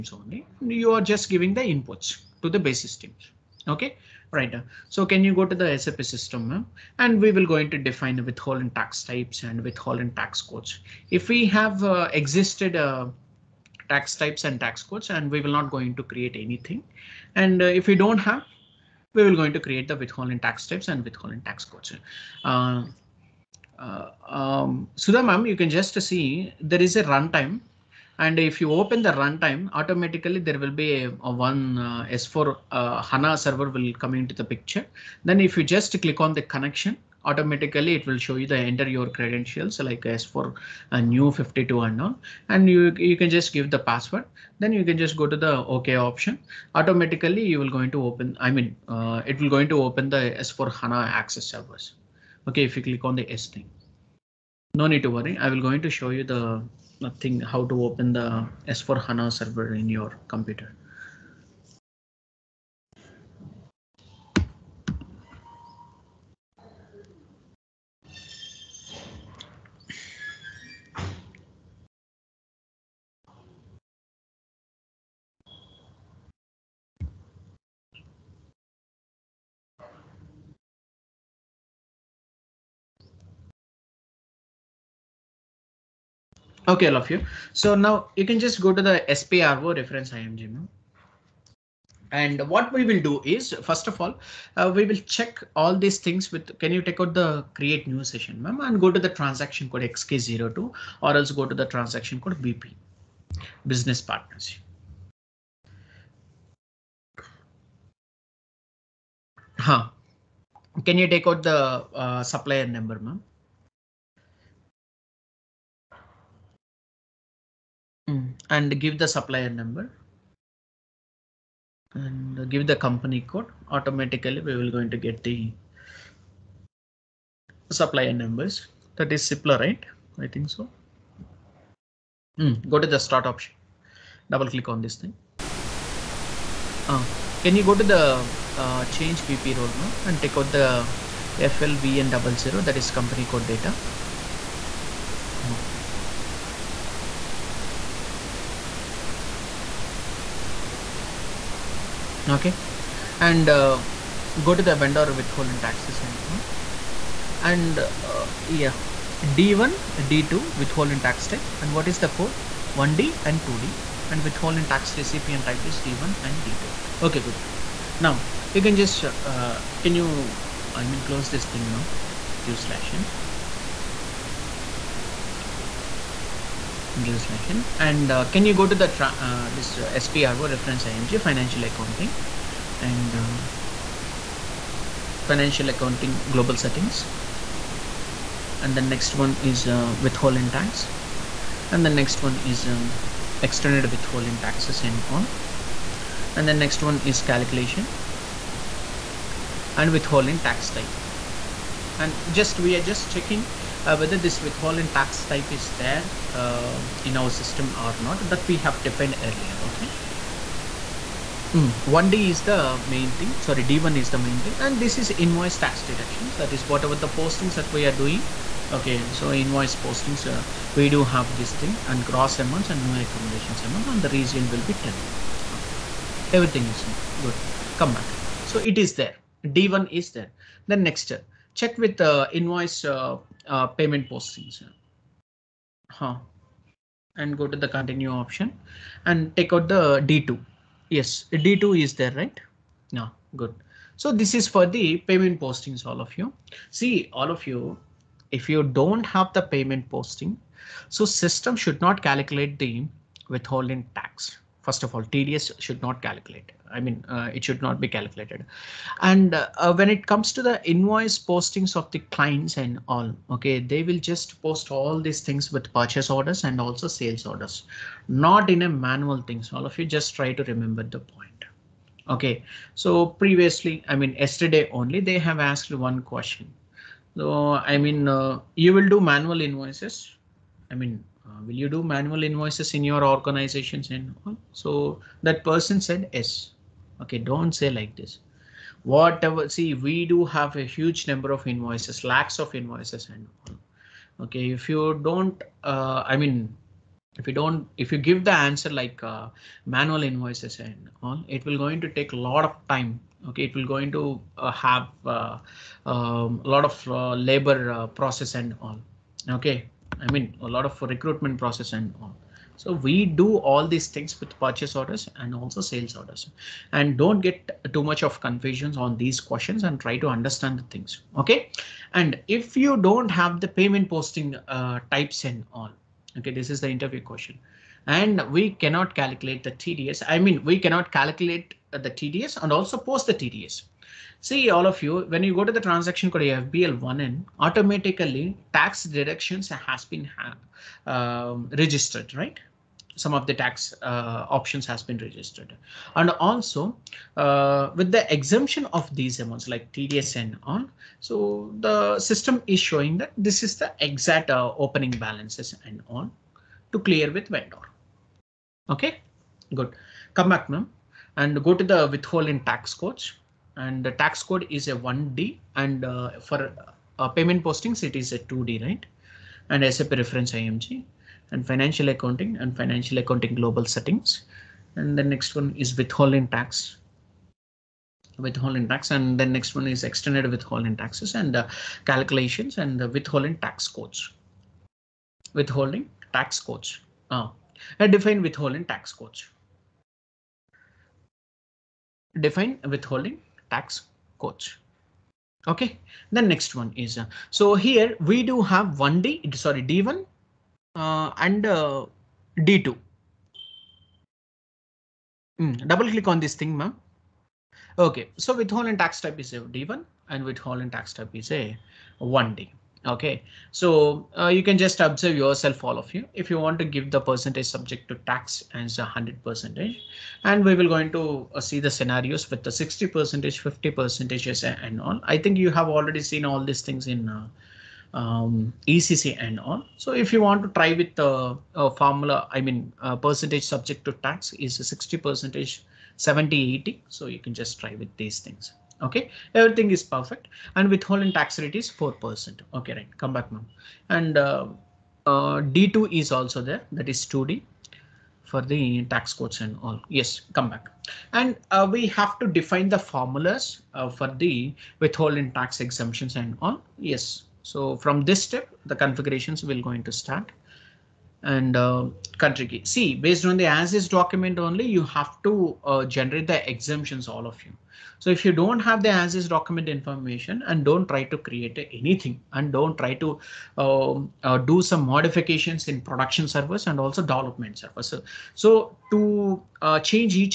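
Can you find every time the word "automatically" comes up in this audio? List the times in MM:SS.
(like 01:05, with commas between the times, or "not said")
00:29, 00:37, 00:46, 02:03, 05:37.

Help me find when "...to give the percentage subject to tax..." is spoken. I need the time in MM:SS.
06:56.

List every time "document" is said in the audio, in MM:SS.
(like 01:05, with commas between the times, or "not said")
07:43, 07:49.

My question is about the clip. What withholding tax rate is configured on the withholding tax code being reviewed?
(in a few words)
4%.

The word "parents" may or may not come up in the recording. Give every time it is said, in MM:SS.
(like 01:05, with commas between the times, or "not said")
not said.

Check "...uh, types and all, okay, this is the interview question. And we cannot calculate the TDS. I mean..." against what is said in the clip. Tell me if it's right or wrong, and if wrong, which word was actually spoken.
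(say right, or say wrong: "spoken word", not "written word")
right.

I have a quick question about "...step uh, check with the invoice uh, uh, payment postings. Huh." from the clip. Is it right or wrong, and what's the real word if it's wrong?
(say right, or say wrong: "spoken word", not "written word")
right.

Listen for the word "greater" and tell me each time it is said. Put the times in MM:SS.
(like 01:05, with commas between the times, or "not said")
not said.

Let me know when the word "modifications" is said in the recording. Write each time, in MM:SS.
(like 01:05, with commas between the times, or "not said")
07:54.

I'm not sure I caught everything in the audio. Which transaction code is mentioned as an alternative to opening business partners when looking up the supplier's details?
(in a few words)
XK02.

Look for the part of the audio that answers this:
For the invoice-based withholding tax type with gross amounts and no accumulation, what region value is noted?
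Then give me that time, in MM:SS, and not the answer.
03:44.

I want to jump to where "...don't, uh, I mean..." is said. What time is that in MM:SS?
04:55.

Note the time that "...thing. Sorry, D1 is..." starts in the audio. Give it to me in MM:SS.
03:33.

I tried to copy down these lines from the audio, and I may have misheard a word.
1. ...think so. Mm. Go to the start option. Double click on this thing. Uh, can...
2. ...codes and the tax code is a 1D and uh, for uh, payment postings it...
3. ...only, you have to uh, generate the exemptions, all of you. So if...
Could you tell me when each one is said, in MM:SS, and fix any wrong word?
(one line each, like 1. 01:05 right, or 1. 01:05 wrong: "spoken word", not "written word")
1. 02:10 right
2. 06:02 right
3. 07:44 right.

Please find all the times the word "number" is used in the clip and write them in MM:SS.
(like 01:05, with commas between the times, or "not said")
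01:52, 01:59, 02:08, 04:51.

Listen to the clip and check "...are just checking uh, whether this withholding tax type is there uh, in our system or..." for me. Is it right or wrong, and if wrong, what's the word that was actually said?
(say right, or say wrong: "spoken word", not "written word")
right.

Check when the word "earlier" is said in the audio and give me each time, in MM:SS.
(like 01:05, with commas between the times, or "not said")
03:29.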